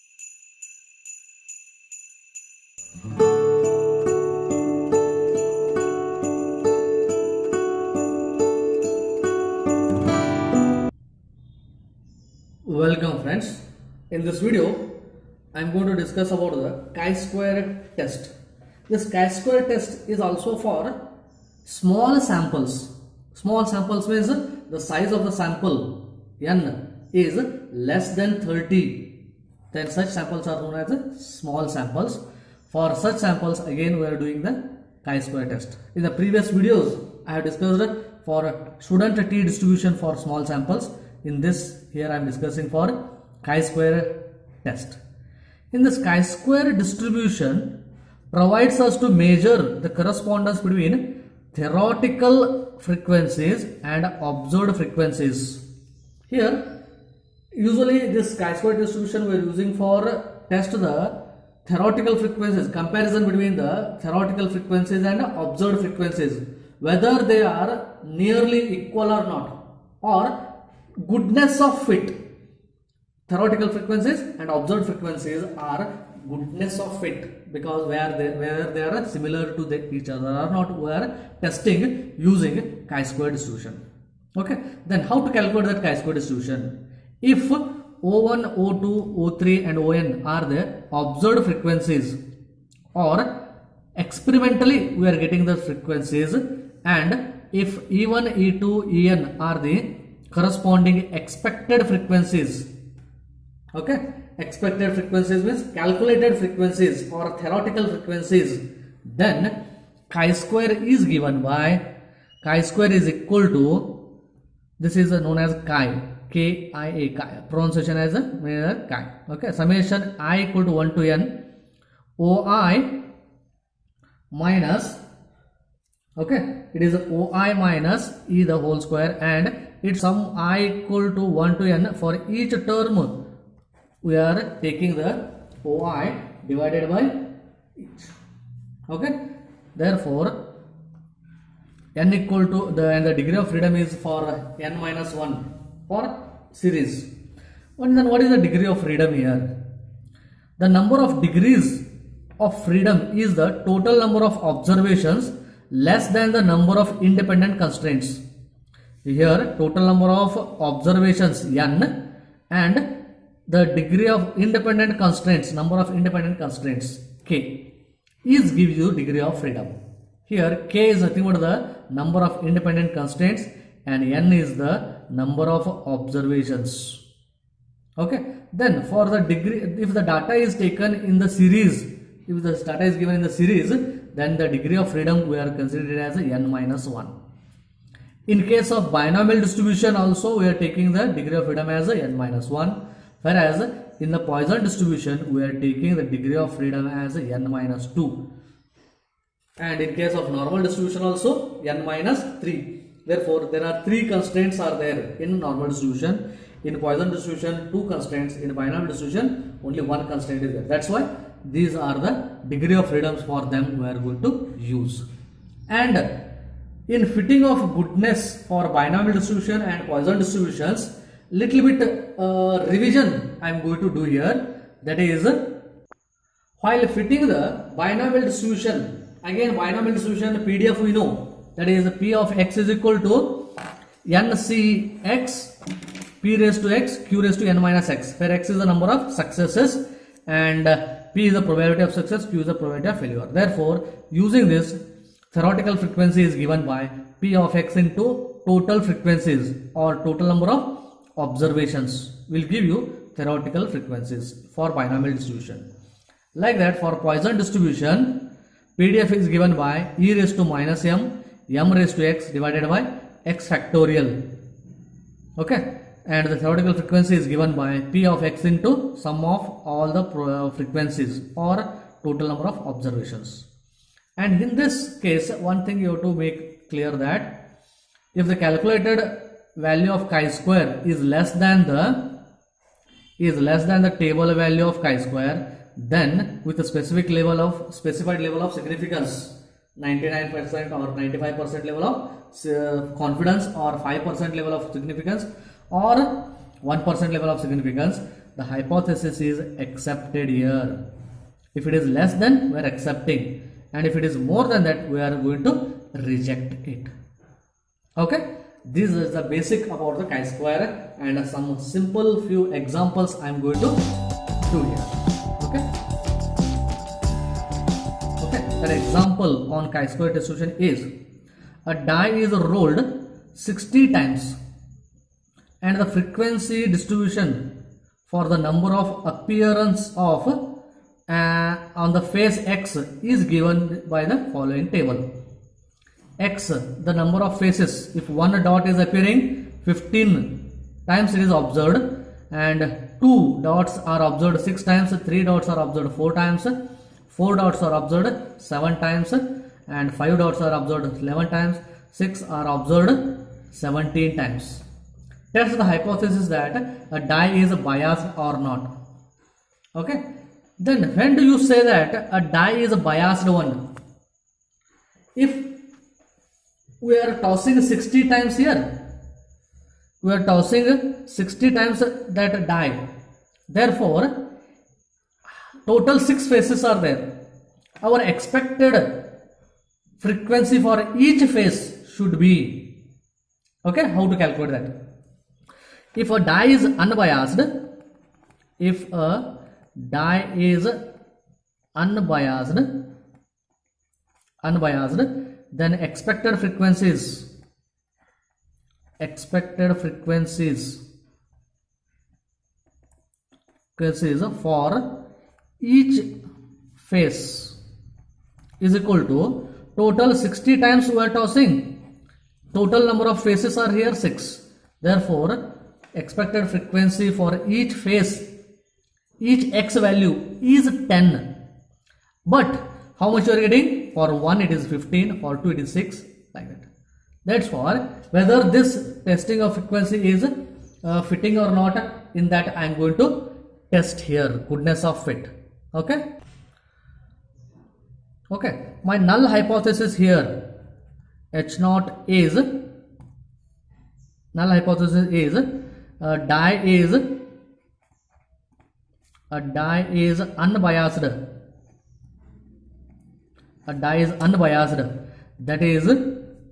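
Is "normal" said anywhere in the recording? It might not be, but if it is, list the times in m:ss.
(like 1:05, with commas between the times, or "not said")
3:20, 3:25.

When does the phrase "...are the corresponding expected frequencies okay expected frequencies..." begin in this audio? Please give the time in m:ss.
1:39.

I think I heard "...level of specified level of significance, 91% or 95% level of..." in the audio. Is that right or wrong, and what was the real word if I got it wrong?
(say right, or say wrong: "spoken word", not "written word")
wrong: "99", not "91".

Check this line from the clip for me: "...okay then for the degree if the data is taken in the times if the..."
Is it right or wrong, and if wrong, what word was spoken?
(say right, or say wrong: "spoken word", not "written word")
wrong: "series", not "times".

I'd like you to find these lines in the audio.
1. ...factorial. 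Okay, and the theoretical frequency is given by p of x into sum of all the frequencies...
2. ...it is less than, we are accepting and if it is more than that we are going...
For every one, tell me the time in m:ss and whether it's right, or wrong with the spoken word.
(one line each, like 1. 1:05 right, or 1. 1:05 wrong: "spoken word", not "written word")
1. 4:23 right
2. 5:01 right.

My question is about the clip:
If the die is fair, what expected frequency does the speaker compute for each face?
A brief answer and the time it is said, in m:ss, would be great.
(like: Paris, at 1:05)
10, at 7:00.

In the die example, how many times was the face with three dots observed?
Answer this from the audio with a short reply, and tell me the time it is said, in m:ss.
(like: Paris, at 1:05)
4, at 5:45.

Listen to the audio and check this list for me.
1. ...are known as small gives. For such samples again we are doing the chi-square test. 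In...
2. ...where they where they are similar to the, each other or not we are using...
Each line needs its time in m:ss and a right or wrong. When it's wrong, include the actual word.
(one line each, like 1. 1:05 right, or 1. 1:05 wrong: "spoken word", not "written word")
1. 0:30 wrong: "samples", not "gives"
2. 1:17 wrong: "testing", not "using".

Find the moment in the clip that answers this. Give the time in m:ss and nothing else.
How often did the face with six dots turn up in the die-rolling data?
5:53.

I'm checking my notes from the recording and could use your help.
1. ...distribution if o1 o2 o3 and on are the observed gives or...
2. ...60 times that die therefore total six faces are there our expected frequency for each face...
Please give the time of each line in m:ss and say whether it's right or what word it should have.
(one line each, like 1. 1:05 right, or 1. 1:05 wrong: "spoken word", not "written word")
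1. 1:26 wrong: "frequencies", not "gives"
2. 6:11 right.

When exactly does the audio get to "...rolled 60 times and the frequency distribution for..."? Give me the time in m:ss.
5:22.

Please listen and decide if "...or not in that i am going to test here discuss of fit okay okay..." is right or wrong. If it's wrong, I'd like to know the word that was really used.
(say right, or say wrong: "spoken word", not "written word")
wrong: "goodness", not "discuss".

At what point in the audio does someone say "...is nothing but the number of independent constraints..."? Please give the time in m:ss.
2:50.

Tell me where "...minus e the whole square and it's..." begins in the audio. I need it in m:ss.
2:07.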